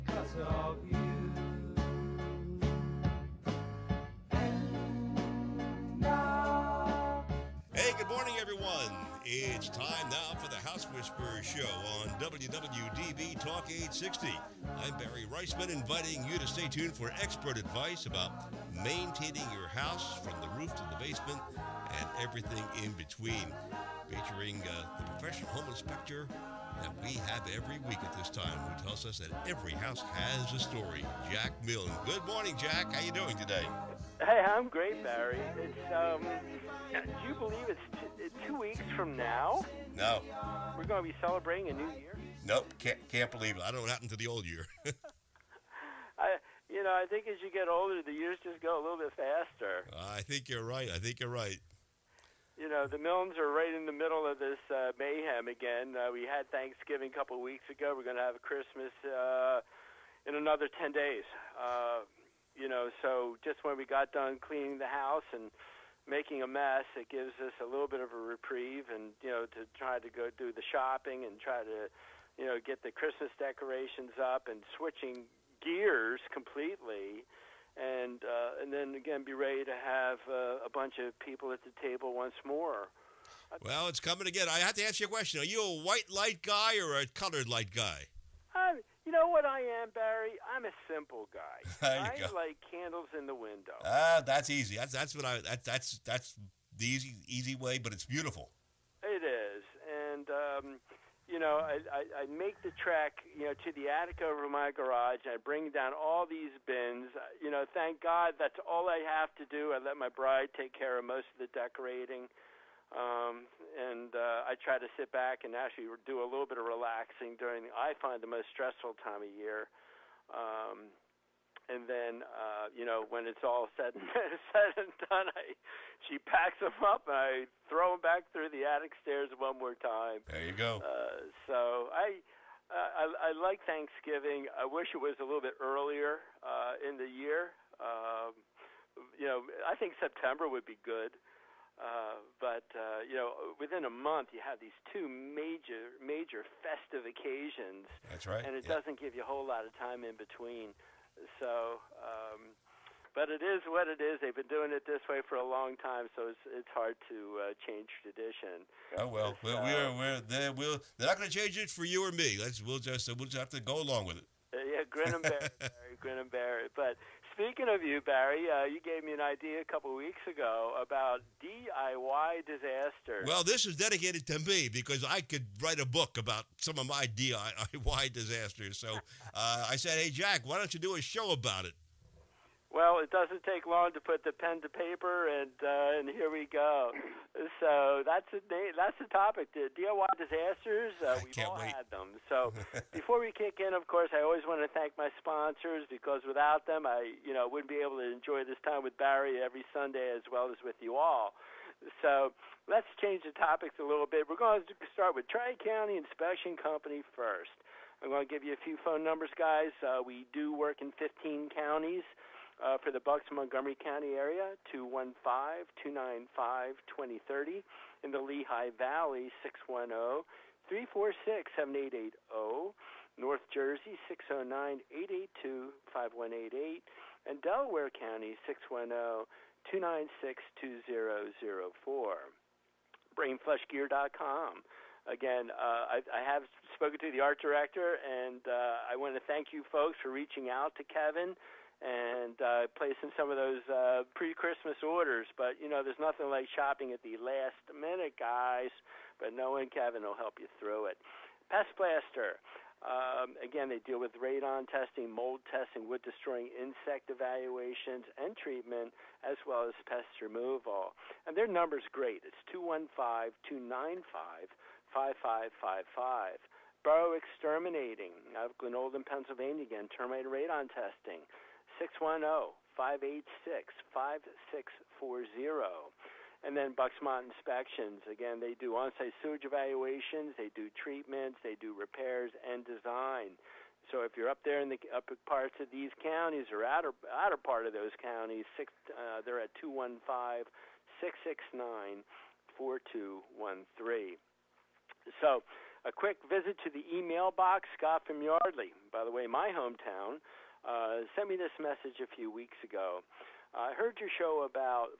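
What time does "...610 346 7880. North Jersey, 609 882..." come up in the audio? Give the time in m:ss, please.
3:39.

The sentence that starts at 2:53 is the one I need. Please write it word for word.
Well, this is dedicated to me because I could write a book about some of my DIY disasters.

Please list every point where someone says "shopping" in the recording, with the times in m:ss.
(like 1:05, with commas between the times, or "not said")
1:10, 4:06.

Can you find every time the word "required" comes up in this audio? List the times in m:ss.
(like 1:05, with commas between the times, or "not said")
not said.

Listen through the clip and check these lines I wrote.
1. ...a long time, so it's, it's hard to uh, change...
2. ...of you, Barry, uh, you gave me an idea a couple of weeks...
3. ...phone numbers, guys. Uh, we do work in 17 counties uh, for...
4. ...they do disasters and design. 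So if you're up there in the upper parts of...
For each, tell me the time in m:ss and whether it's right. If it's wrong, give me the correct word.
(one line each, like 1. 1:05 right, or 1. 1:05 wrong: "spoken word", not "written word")
1. 2:35 right
2. 2:47 right
3. 3:28 wrong: "15", not "17"
4. 4:41 wrong: "repairs", not "disasters".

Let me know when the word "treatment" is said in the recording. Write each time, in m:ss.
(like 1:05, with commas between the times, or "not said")
4:18, 4:40.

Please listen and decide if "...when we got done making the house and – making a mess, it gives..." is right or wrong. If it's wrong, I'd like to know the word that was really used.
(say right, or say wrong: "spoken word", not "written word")
wrong: "cleaning", not "making".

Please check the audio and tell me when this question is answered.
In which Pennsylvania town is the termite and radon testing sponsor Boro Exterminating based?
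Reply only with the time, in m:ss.
4:28.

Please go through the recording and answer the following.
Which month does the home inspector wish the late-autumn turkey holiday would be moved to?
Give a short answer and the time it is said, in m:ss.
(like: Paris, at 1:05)
September, at 2:19.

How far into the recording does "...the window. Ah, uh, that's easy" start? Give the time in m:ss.
1:33.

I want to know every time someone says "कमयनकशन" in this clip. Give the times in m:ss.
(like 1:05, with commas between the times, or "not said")
not said.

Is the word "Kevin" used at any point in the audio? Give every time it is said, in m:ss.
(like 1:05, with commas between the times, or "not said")
4:00, 4:09.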